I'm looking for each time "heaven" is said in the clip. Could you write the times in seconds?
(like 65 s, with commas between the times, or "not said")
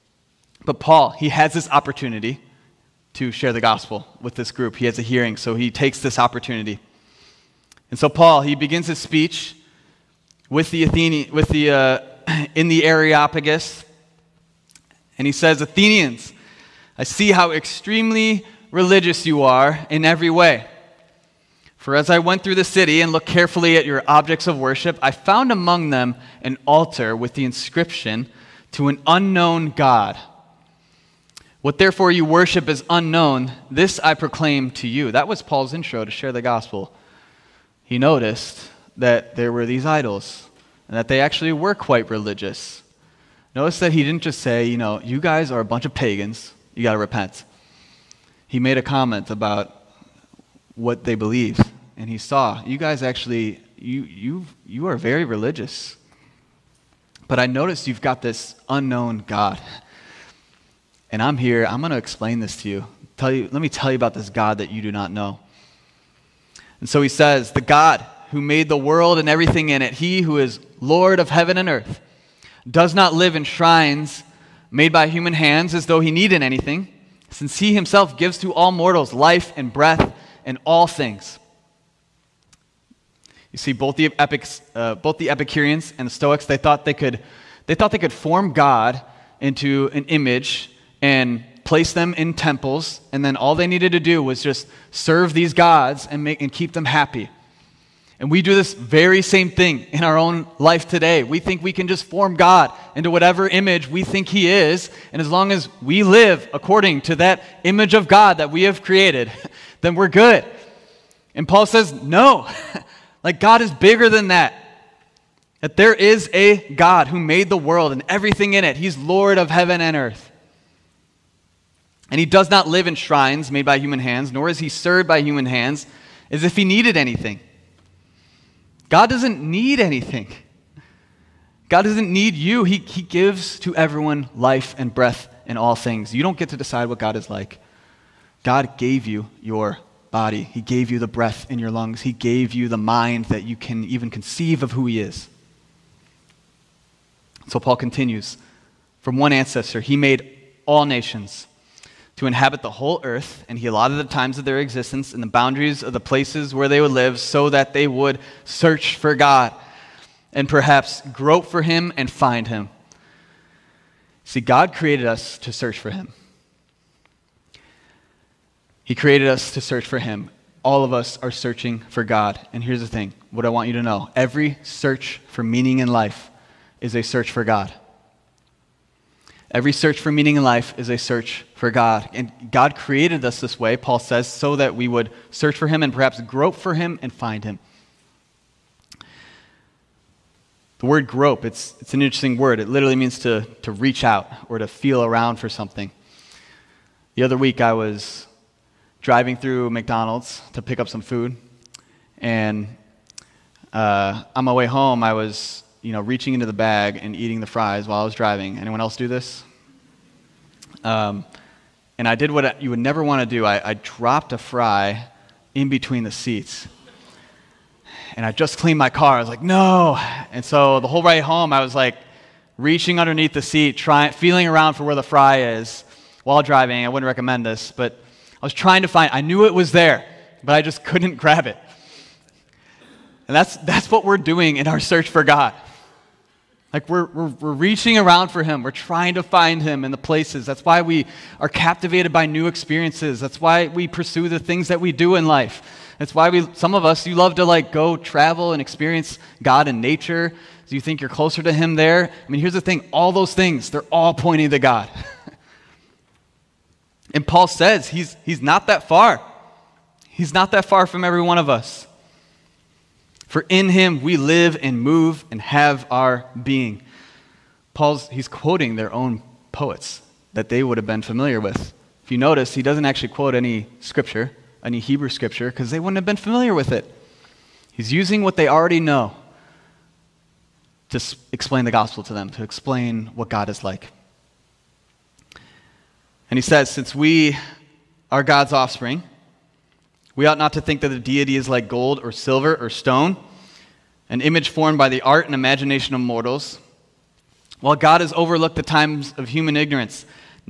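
71 s, 119 s.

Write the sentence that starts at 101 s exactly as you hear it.
We think we can just form God into whatever image we think He is.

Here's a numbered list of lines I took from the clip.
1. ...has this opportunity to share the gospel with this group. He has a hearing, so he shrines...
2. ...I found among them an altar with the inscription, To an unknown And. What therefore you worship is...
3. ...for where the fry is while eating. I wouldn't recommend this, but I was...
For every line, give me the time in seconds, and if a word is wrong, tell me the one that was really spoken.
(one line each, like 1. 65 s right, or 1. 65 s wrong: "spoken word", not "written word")
1. 1 s wrong: "takes", not "shrines"
2. 25 s wrong: "God", not "And"
3. 224 s wrong: "driving", not "eating".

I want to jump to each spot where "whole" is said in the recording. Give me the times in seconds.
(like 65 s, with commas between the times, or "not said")
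152 s, 220 s.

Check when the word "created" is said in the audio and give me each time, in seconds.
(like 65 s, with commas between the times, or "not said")
108 s, 164 s, 168 s, 182 s.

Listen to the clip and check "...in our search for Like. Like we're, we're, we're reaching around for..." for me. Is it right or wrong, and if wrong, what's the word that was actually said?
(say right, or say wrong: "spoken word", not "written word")
wrong: "God", not "Like".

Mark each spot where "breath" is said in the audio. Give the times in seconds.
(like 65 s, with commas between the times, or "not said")
79 s, 134 s, 141 s.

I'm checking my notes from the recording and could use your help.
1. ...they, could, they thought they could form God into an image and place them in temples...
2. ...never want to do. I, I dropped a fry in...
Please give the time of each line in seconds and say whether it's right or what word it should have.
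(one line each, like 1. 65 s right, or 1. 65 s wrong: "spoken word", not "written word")
1. 86 s right
2. 212 s right.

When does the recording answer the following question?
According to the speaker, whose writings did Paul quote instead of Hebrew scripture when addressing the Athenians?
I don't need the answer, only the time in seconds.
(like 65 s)
268 s.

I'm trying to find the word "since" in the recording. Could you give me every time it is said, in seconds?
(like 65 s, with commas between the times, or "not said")
77 s, 286 s.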